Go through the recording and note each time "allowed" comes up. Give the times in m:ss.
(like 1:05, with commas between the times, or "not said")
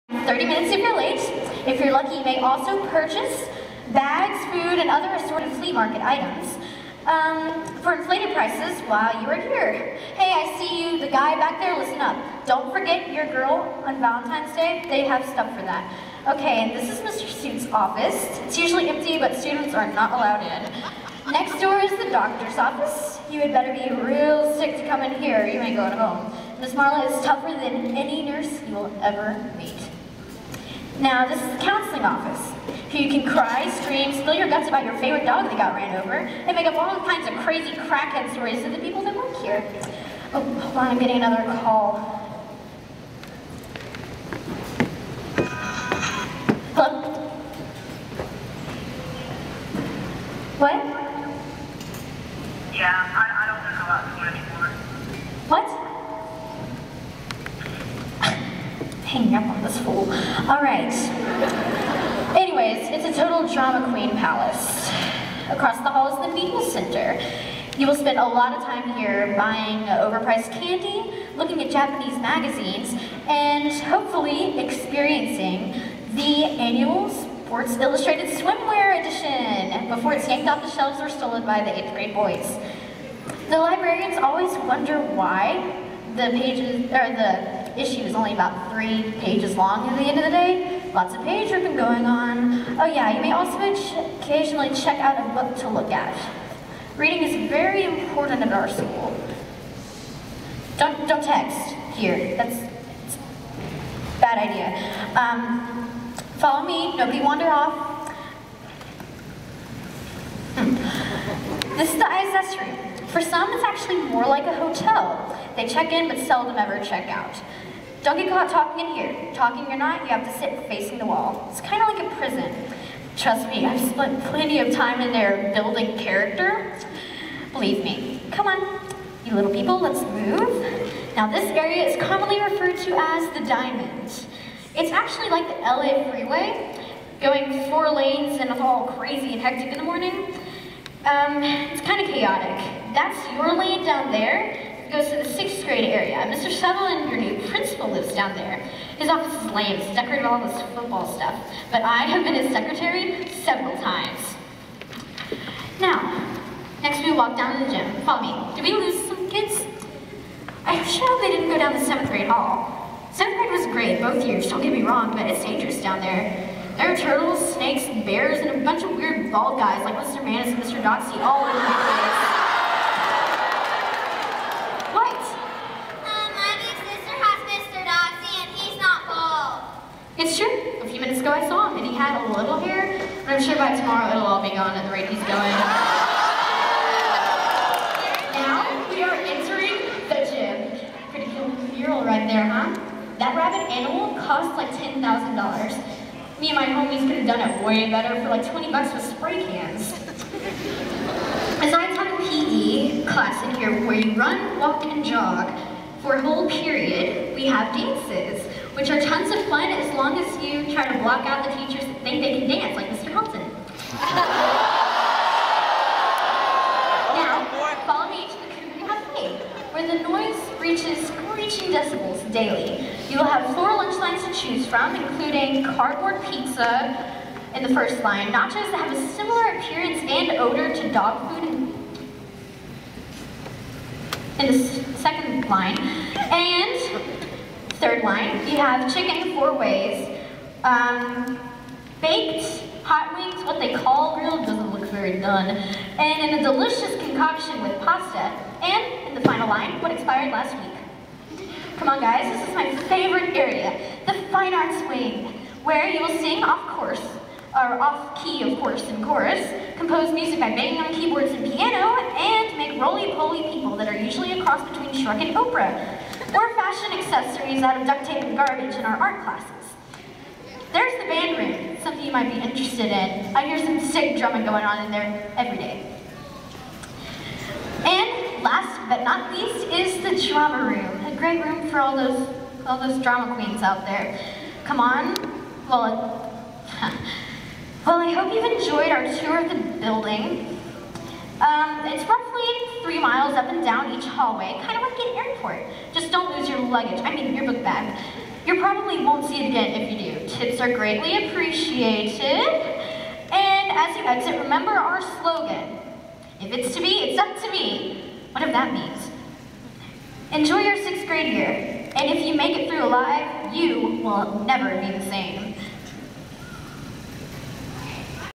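0:20.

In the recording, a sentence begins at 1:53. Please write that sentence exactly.
For some, it's actually more like a hotel.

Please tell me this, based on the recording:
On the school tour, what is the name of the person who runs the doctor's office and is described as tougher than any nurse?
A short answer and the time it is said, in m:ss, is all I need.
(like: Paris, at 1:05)
Miss Marla, at 0:26.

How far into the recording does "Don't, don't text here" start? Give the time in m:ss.
1:40.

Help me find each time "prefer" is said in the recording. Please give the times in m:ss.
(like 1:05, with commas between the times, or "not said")
not said.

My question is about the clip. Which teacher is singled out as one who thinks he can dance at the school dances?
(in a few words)
Mr. Helton.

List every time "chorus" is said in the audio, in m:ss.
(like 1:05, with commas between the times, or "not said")
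4:19.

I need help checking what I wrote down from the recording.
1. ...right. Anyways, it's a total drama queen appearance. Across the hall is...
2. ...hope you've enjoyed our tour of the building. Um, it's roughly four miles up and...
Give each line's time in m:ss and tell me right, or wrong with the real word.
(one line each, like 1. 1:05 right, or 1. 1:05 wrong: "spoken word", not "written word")
1. 1:00 wrong: "palace", not "appearance"
2. 4:48 wrong: "three", not "four".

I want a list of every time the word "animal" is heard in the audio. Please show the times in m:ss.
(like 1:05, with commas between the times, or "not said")
3:13.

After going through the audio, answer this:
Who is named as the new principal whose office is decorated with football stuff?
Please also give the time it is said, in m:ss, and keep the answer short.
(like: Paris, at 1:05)
Mr. Sutherland, at 2:26.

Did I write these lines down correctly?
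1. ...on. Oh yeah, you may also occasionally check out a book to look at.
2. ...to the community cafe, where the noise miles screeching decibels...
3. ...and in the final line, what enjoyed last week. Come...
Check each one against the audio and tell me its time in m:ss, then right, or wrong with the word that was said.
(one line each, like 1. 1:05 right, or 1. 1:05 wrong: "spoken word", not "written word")
1. 1:32 right
2. 3:38 wrong: "reaches", not "miles"
3. 4:08 wrong: "expired", not "enjoyed".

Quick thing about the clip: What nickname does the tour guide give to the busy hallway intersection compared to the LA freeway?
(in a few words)
the Diamond.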